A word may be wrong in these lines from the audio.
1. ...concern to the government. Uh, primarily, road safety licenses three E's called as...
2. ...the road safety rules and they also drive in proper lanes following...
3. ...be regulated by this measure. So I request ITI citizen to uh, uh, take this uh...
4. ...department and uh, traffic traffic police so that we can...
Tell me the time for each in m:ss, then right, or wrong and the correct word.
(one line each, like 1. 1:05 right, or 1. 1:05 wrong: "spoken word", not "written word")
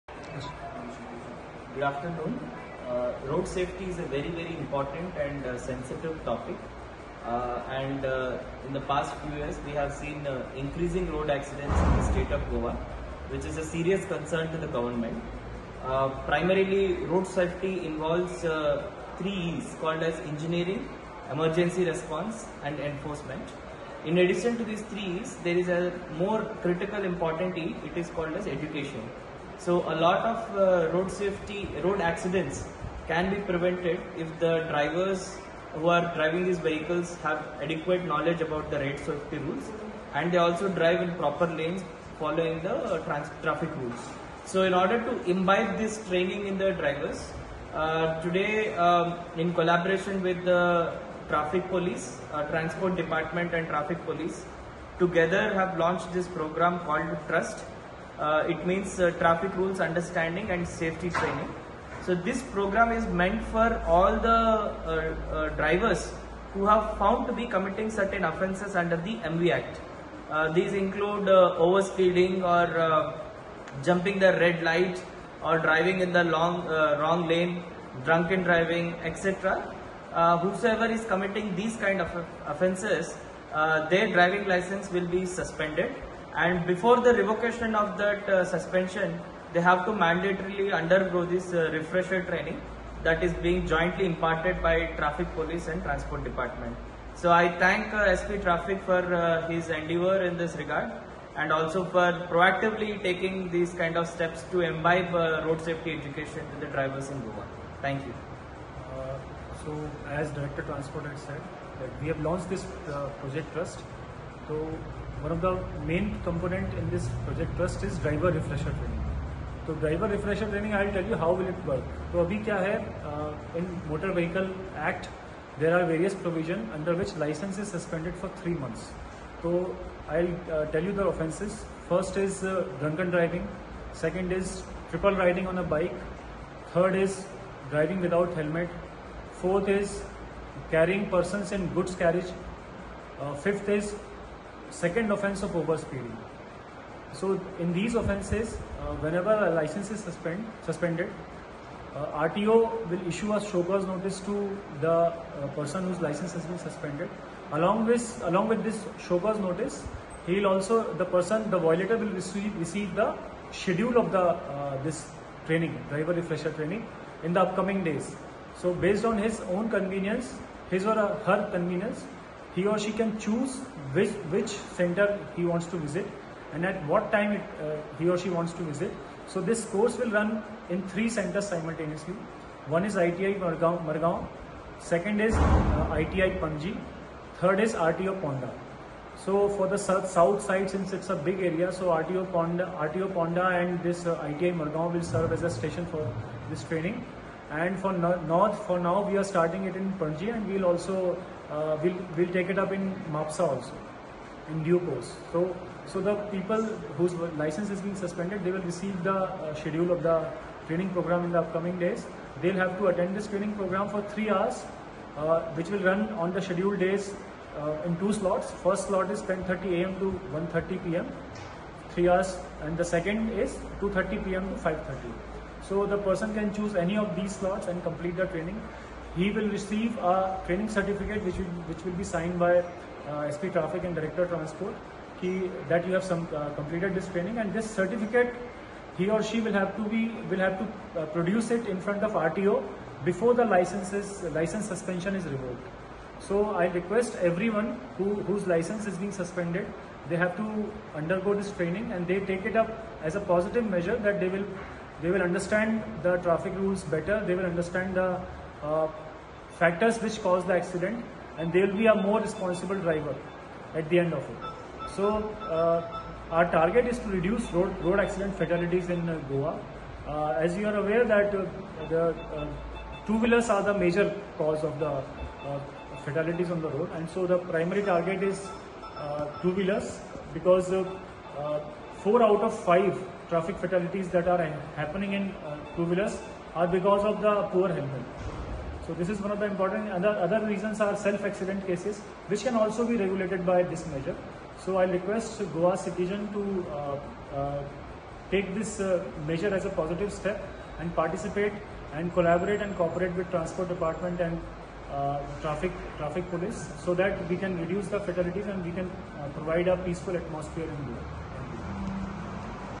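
1. 0:14 wrong: "involves", not "licenses"
2. 0:38 right
3. 4:52 wrong: "Goa", not "ITI"
4. 5:03 right.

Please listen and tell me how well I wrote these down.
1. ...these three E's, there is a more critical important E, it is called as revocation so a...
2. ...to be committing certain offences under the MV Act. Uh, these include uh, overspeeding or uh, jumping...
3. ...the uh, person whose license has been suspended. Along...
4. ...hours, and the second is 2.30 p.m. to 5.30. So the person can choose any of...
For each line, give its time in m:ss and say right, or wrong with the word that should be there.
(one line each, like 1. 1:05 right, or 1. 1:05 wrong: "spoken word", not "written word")
1. 0:24 wrong: "education", not "revocation"
2. 1:07 right
3. 2:34 right
4. 3:42 right.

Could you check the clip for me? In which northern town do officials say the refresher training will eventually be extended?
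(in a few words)
Mapsa.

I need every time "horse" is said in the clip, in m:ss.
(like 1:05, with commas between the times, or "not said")
not said.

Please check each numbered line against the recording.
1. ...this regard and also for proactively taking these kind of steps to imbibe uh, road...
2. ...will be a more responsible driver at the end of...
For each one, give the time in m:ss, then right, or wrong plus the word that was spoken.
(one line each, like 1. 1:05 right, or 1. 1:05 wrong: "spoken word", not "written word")
1. 1:40 right
2. 4:21 right.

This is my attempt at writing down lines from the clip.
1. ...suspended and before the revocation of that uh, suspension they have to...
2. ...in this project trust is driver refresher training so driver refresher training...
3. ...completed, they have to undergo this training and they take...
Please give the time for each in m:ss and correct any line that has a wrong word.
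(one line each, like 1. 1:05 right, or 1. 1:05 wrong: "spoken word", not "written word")
1. 1:25 right
2. 1:56 right
3. 4:09 wrong: "suspended", not "completed".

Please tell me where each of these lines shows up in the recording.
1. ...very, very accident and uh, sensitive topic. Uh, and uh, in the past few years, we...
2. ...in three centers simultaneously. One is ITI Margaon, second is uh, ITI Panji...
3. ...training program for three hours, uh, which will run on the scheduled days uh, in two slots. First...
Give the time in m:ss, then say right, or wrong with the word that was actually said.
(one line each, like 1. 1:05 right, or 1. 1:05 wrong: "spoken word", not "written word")
1. 0:04 wrong: "important", not "accident"
2. 3:00 right
3. 3:33 right.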